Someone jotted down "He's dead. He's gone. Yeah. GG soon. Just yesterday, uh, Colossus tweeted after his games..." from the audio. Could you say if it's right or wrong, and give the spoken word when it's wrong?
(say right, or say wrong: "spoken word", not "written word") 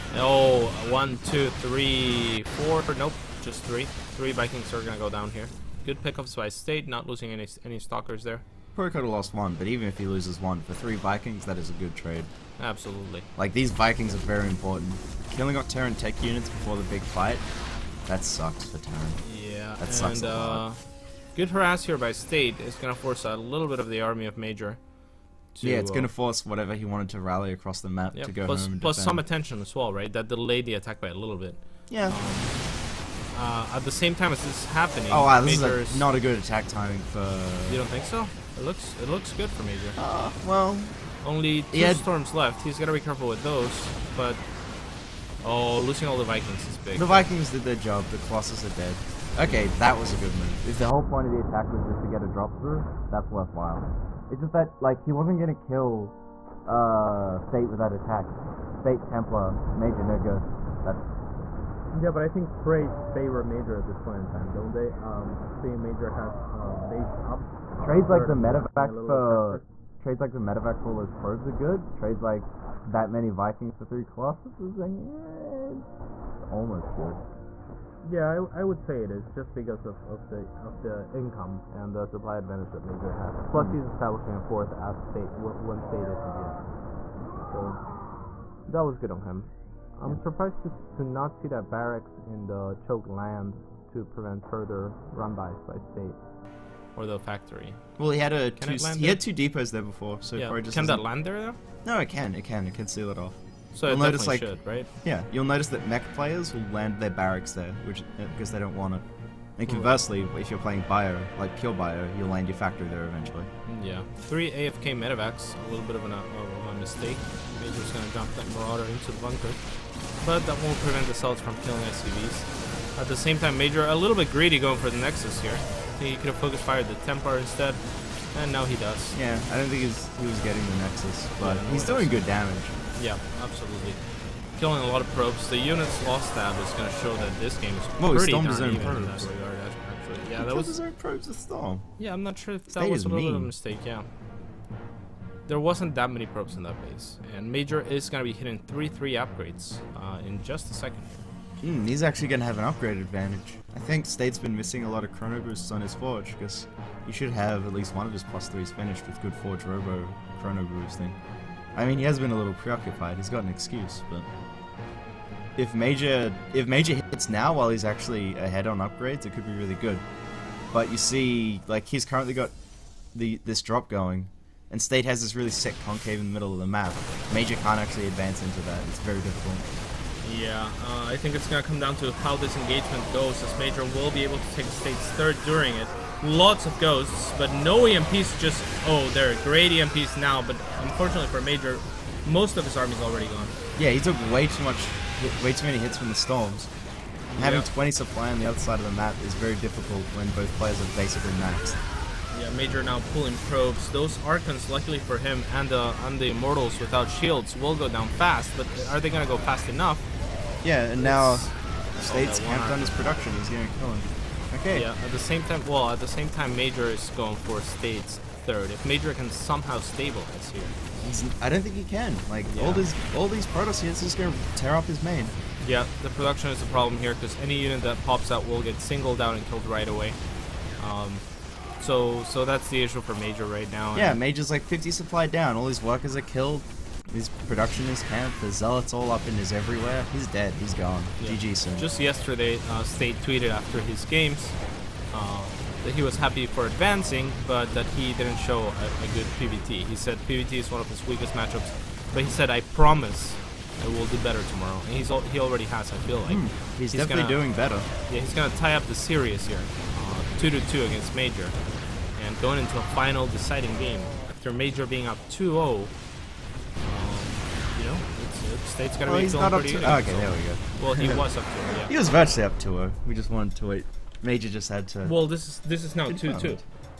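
wrong: "State", not "Colossus".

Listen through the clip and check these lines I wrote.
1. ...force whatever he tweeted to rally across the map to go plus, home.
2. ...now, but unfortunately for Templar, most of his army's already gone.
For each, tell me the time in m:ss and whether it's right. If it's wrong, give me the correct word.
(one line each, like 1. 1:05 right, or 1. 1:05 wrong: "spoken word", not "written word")
1. 0:26 wrong: "wanted", not "tweeted"
2. 3:10 wrong: "Major", not "Templar".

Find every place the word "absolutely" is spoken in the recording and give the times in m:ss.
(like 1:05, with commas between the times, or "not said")
0:12, 2:13.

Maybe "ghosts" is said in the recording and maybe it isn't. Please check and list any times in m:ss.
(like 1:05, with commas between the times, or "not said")
1:00, 3:06.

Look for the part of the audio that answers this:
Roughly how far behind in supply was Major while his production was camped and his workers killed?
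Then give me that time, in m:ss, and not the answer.
3:54.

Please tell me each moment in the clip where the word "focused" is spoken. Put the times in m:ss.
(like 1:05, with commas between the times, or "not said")
2:06.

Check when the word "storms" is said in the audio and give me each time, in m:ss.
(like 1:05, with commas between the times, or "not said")
0:41, 2:21, 3:16.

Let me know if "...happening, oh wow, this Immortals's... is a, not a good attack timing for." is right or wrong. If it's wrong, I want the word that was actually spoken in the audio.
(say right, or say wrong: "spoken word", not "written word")
wrong: "Major", not "Immortals".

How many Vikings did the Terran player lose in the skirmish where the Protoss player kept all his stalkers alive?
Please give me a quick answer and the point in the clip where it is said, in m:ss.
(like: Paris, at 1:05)
3, at 0:04.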